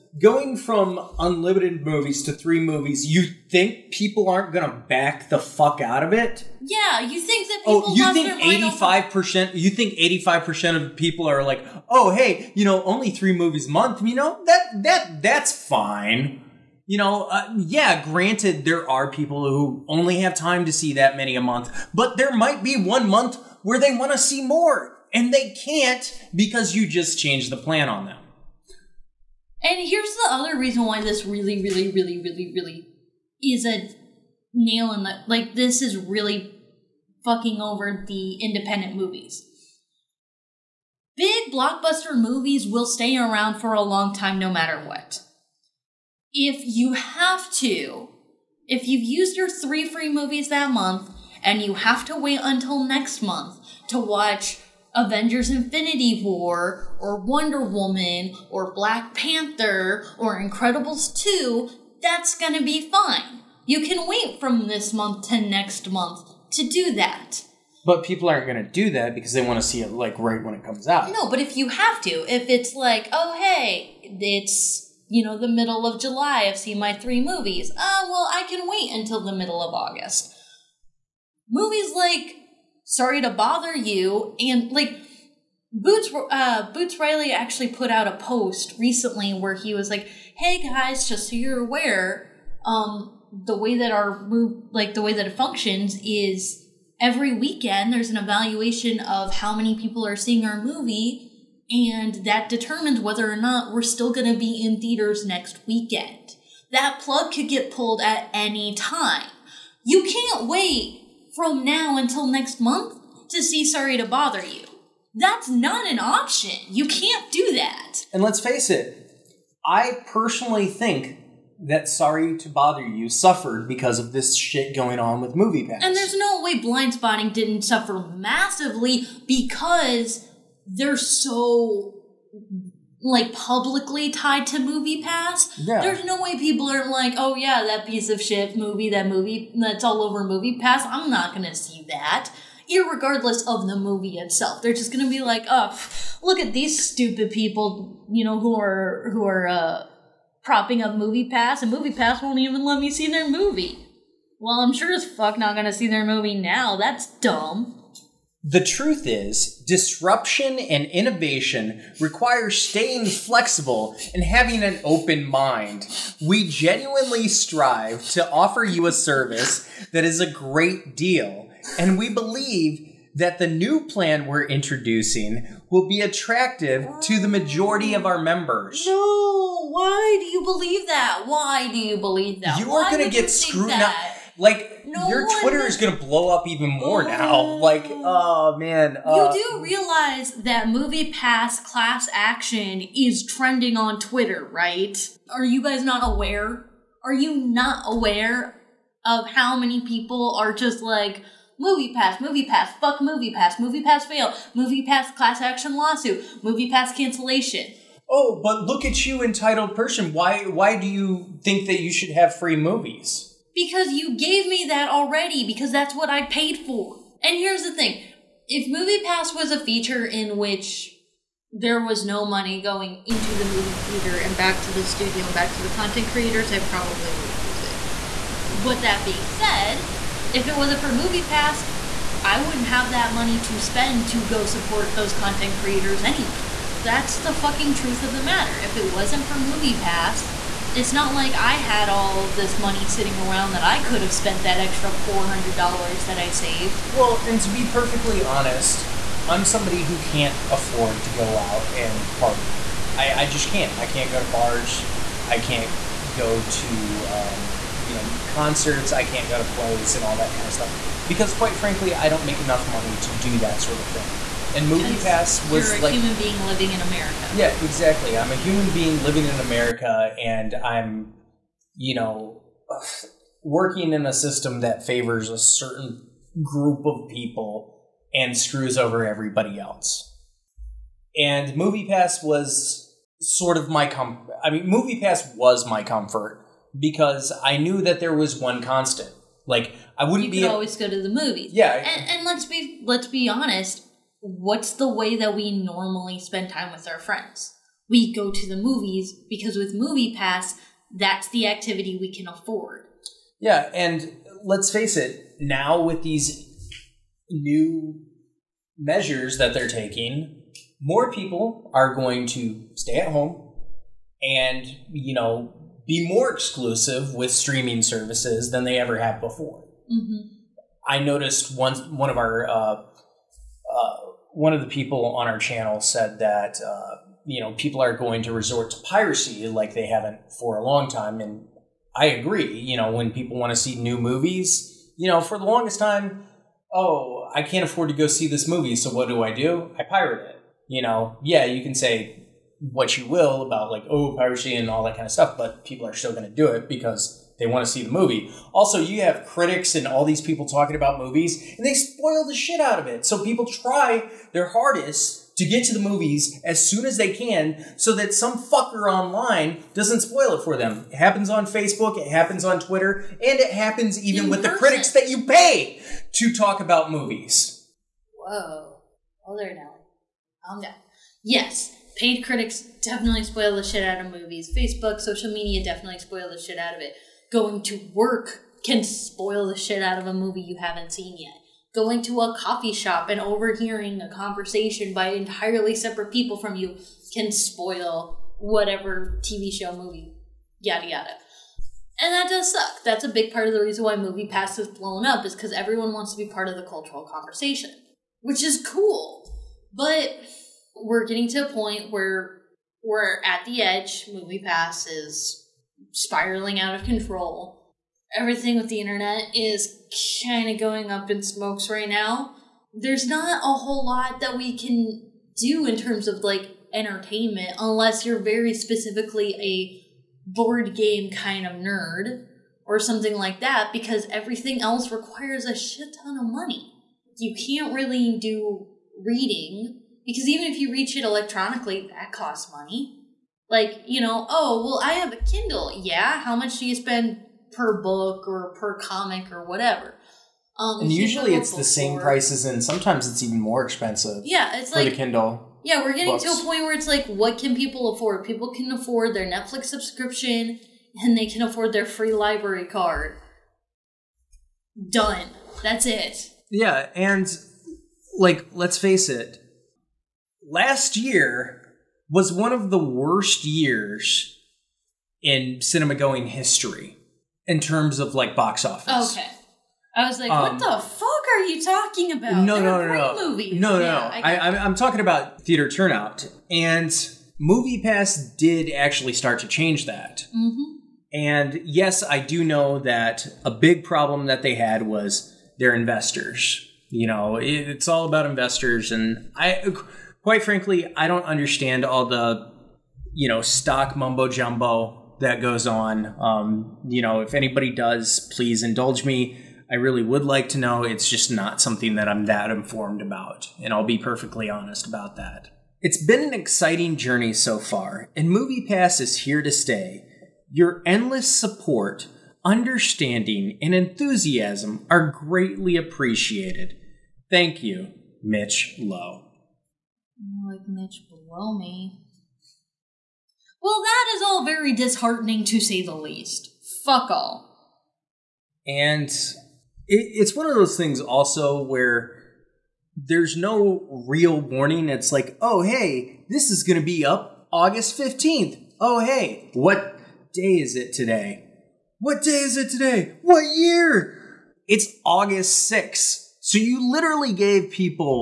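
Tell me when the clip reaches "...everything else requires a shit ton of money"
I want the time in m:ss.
7:04.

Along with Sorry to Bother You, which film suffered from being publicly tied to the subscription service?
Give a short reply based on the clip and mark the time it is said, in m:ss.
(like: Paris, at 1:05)
Blindspotting, at 2:06.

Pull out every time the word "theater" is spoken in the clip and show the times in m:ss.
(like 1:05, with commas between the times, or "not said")
1:44, 3:43, 7:55.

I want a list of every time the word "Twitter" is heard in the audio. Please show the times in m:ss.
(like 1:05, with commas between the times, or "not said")
3:05, 3:13, 6:02.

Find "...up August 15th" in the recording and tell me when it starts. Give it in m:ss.
8:57.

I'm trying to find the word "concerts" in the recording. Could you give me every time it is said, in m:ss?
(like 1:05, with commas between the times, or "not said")
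4:18.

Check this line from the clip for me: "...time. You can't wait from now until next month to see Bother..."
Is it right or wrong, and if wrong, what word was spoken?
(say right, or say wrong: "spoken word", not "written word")
wrong: "Sorry", not "Bother".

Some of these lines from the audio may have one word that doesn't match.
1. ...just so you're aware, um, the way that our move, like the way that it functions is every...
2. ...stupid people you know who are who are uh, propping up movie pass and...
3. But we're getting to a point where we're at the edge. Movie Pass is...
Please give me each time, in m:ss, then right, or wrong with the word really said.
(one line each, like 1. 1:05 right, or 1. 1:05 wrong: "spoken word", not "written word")
1. 1:31 right
2. 2:26 right
3. 6:39 right.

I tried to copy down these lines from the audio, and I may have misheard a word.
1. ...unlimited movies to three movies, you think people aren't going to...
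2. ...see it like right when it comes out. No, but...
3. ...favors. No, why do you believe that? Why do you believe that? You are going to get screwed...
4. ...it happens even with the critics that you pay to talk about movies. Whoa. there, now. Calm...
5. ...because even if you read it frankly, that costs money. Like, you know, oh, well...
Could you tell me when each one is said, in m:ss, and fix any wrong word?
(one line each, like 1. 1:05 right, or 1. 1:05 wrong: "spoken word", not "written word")
1. 0:01 right
2. 1:09 right
3. 2:58 wrong: "members", not "favors"
4. 6:03 right
5. 7:10 wrong: "electronically", not "frankly".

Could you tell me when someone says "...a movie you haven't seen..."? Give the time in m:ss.
6:20.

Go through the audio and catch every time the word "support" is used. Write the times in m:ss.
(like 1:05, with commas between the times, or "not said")
3:54, 8:31.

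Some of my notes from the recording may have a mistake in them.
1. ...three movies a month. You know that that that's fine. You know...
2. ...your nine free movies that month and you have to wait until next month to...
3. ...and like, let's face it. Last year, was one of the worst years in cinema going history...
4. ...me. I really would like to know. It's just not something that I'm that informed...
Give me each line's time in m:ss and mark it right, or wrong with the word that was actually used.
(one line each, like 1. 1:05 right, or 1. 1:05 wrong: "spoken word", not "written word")
1. 0:13 right
2. 0:49 wrong: "three", not "nine"
3. 7:36 right
4. 8:19 right.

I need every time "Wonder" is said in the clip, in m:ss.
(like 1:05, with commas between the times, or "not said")
0:57.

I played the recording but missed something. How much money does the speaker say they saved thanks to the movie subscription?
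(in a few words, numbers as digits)
$400.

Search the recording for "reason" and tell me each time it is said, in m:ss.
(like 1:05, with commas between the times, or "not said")
0:30, 6:33.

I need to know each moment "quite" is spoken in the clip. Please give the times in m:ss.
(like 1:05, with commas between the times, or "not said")
4:21, 8:10.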